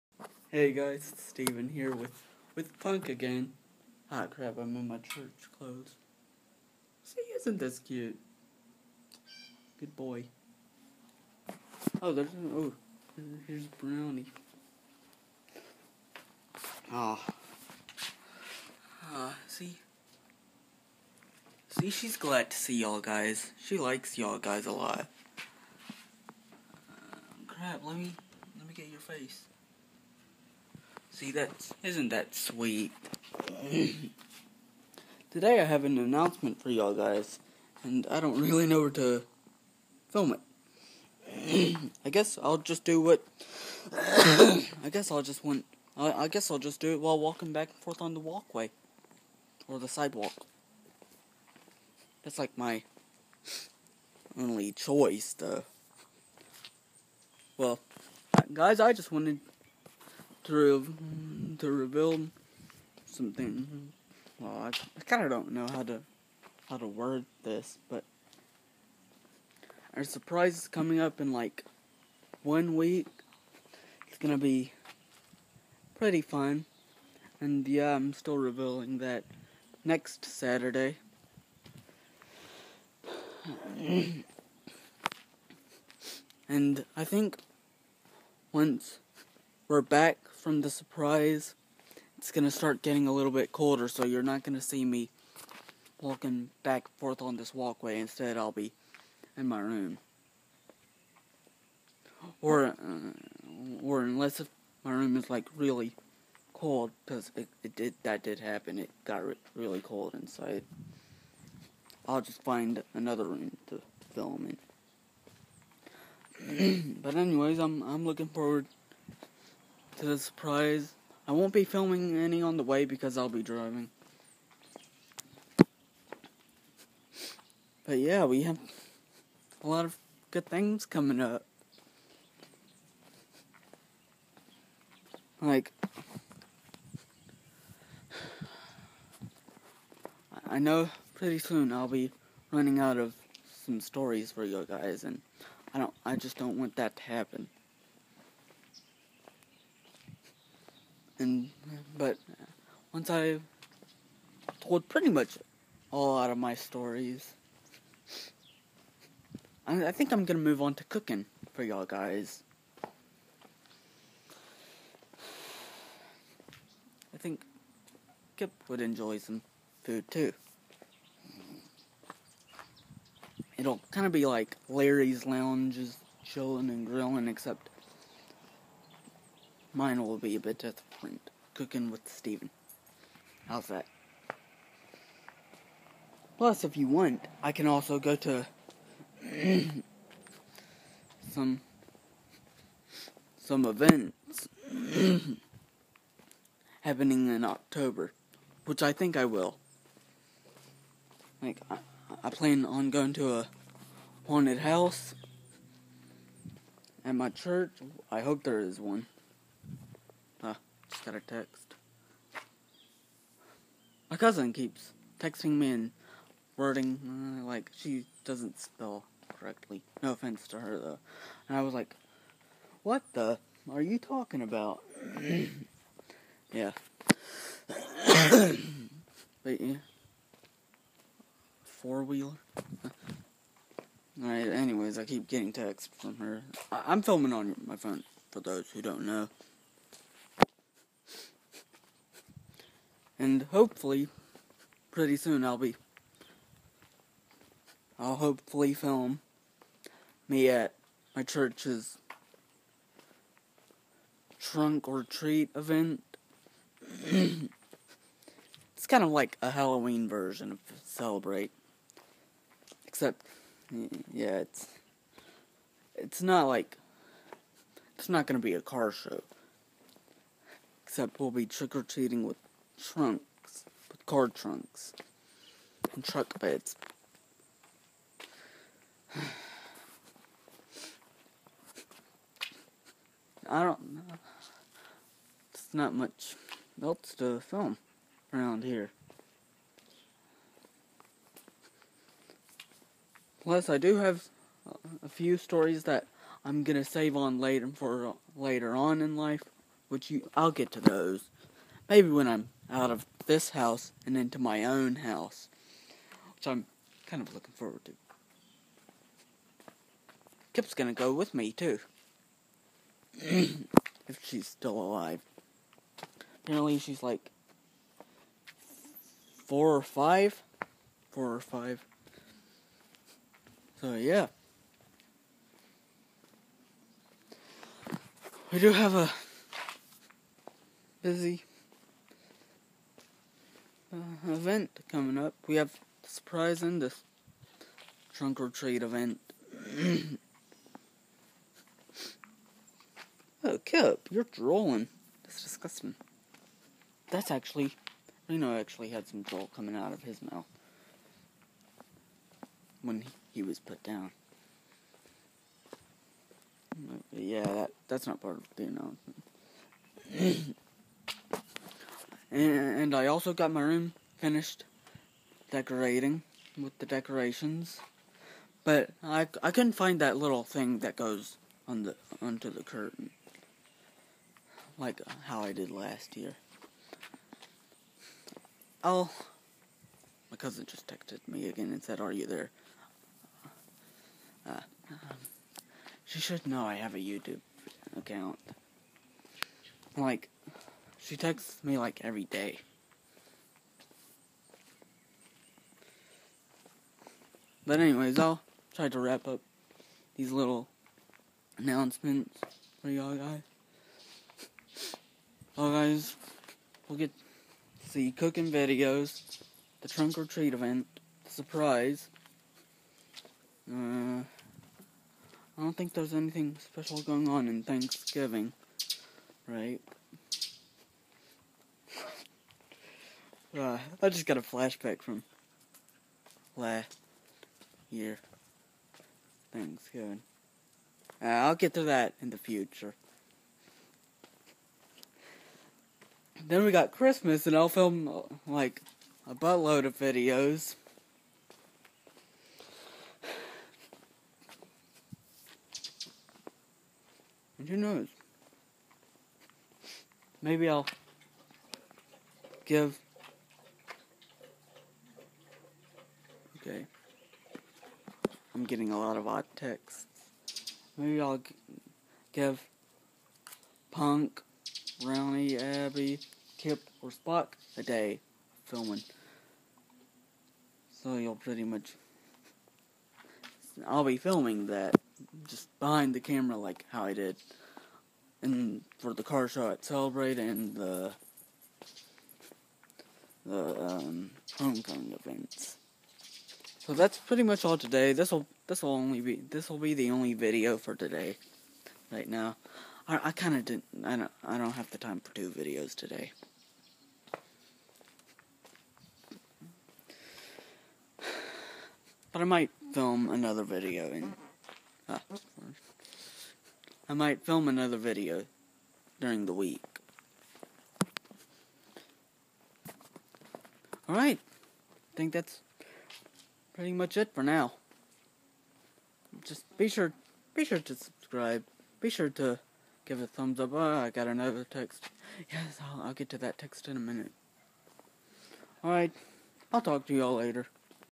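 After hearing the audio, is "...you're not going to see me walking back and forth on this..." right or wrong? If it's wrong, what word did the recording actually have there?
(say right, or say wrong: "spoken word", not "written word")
right.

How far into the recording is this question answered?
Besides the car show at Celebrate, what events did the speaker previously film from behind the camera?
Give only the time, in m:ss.
8:04.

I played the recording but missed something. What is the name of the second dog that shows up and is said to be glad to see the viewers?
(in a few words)
Brownie.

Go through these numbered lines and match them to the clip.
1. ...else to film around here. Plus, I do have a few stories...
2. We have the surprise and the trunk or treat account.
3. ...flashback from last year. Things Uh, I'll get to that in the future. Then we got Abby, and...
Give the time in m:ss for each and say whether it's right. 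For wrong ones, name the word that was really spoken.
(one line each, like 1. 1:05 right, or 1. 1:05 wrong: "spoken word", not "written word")
1. 4:46 right
2. 5:35 wrong: "event", not "account"
3. 7:04 wrong: "Christmas", not "Abby".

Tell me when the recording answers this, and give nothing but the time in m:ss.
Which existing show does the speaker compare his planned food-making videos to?
2:54.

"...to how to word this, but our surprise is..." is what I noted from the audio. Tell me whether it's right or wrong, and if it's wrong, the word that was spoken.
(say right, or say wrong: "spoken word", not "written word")
right.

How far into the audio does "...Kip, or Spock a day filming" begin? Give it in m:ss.
7:46.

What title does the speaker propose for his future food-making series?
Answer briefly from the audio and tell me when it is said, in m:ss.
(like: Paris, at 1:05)
Cooking with Steven, at 3:01.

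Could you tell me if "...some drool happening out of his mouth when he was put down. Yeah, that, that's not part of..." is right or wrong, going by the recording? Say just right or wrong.
wrong.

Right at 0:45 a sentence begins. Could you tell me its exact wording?
I, I guess I'll just do it while walking back and forth on the walkway.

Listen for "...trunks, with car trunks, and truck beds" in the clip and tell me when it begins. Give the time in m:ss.
4:32.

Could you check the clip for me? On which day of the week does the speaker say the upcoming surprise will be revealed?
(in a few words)
Saturday.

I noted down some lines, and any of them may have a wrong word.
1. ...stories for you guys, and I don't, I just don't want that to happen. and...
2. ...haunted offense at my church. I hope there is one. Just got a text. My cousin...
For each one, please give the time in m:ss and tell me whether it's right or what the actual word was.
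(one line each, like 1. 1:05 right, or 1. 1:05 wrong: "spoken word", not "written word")
1. 2:23 right
2. 3:24 wrong: "house", not "offense".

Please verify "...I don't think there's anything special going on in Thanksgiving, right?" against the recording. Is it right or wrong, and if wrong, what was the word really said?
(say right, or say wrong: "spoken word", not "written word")
right.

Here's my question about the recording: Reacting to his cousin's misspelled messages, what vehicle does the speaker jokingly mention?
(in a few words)
Four wheeler.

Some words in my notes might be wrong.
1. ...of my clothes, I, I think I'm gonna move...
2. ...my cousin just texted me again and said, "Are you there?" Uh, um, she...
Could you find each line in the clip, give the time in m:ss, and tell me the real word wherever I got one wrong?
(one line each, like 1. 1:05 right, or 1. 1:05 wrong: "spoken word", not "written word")
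1. 2:36 wrong: "stories", not "clothes"
2. 6:20 right.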